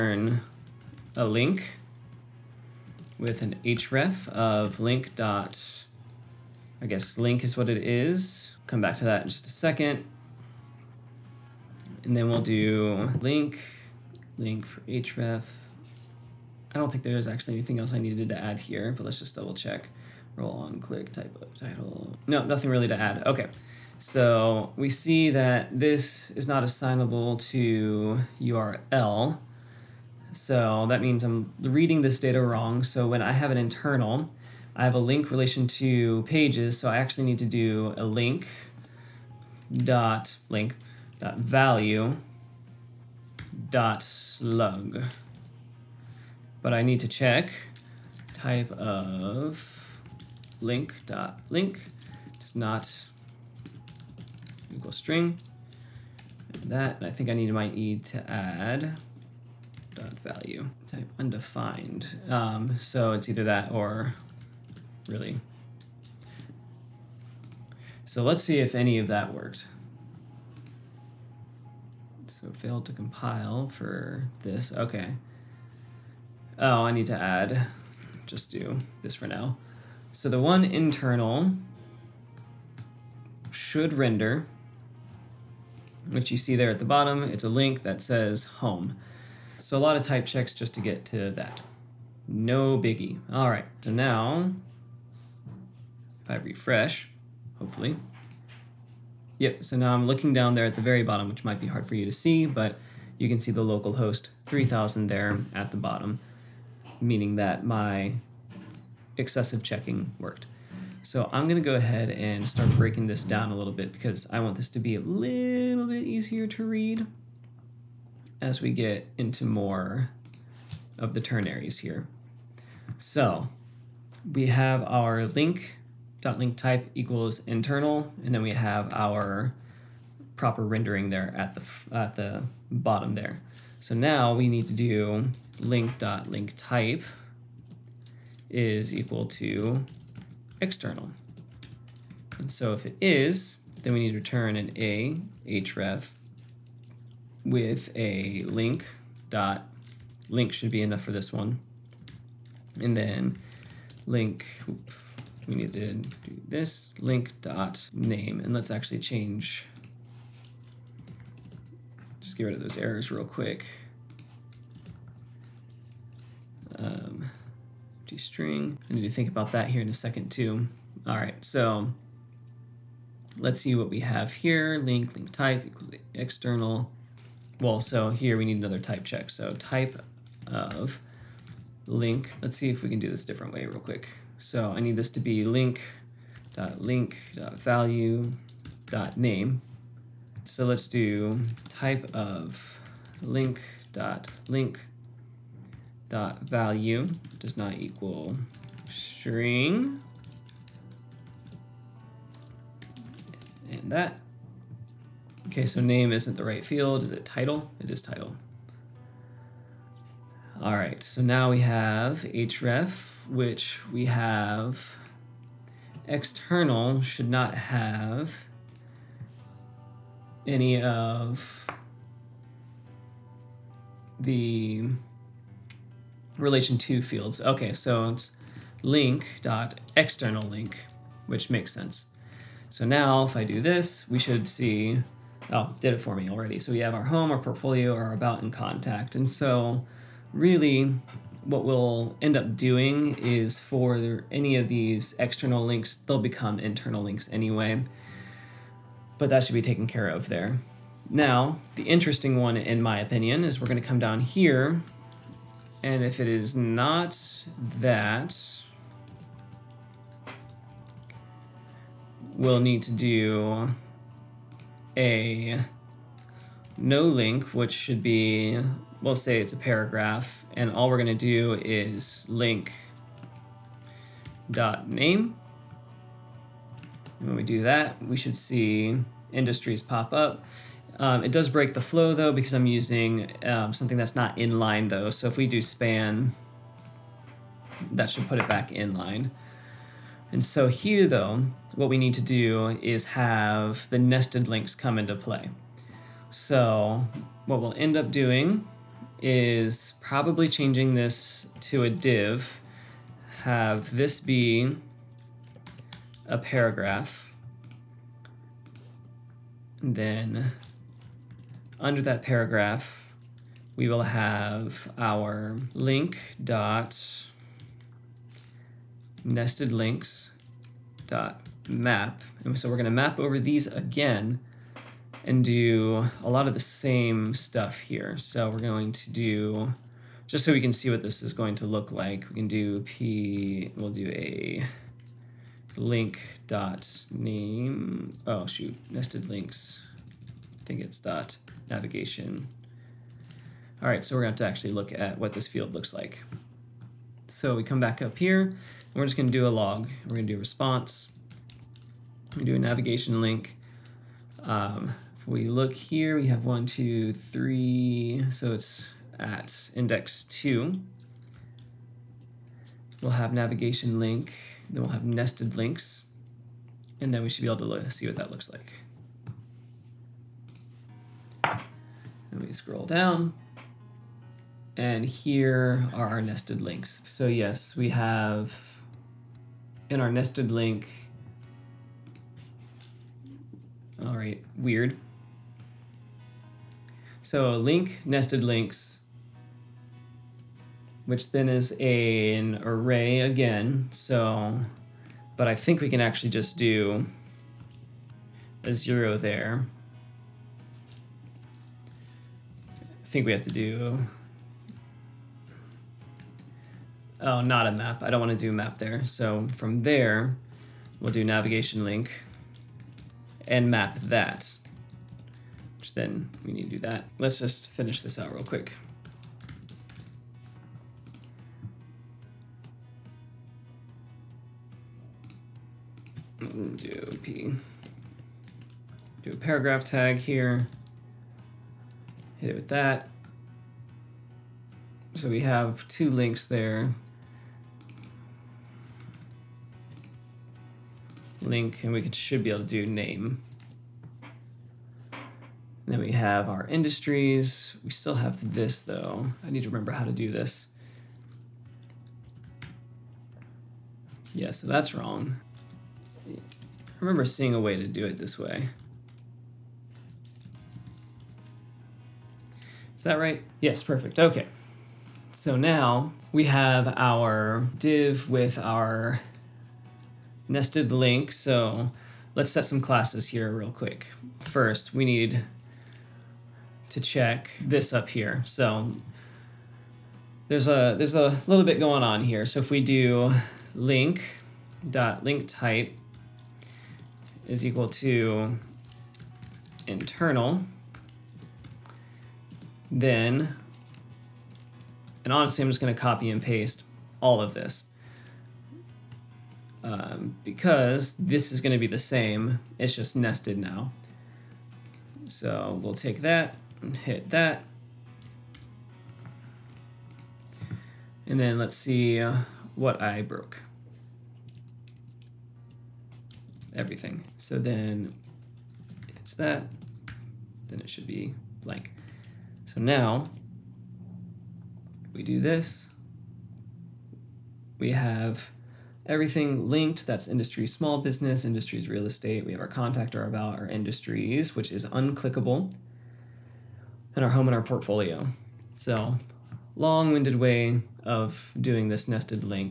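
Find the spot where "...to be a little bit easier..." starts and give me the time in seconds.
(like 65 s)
114 s.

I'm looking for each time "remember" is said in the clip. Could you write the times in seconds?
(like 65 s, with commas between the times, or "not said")
449 s, 456 s.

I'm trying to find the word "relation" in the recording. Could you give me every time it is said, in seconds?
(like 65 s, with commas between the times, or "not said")
35 s, 226 s.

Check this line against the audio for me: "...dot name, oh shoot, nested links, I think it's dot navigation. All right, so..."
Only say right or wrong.
right.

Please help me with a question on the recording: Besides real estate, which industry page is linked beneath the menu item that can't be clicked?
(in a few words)
small business.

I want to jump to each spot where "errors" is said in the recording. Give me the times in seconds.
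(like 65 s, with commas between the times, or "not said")
162 s.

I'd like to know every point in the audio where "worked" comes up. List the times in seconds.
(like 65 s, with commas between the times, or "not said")
69 s, 110 s.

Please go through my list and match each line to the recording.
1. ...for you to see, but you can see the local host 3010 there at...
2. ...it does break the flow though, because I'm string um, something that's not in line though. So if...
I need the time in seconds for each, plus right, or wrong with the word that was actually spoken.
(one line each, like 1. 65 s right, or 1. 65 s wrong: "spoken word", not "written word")
1. 101 s wrong: "3000", not "3010"
2. 281 s wrong: "using", not "string".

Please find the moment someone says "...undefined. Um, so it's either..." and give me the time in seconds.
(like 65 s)
61 s.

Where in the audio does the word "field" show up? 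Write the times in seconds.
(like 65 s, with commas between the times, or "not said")
206 s, 227 s, 345 s.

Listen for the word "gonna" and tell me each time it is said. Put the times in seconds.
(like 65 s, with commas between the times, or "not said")
111 s, 495 s.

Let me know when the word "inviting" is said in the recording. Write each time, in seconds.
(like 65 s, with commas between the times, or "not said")
not said.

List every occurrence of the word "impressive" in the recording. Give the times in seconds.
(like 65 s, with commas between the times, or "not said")
not said.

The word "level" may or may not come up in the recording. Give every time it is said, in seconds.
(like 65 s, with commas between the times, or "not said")
not said.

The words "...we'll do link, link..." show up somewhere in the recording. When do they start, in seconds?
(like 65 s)
12 s.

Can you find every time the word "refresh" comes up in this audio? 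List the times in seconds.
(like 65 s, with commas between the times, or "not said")
96 s.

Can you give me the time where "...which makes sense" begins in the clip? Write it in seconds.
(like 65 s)
231 s.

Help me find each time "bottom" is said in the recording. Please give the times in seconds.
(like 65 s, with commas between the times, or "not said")
86 s, 101 s, 105 s, 132 s.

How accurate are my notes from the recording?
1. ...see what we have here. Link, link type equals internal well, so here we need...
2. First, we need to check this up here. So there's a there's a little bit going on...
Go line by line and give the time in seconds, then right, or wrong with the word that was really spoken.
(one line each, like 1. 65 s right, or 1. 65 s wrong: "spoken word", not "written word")
1. 173 s wrong: "external", not "internal"
2. 474 s right.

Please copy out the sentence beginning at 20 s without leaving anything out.
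Roll on, click, type of title.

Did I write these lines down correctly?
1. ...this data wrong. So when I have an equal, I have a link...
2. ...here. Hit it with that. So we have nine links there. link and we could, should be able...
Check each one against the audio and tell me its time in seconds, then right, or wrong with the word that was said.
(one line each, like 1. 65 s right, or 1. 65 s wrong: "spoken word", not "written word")
1. 32 s wrong: "internal", not "equal"
2. 430 s wrong: "two", not "nine".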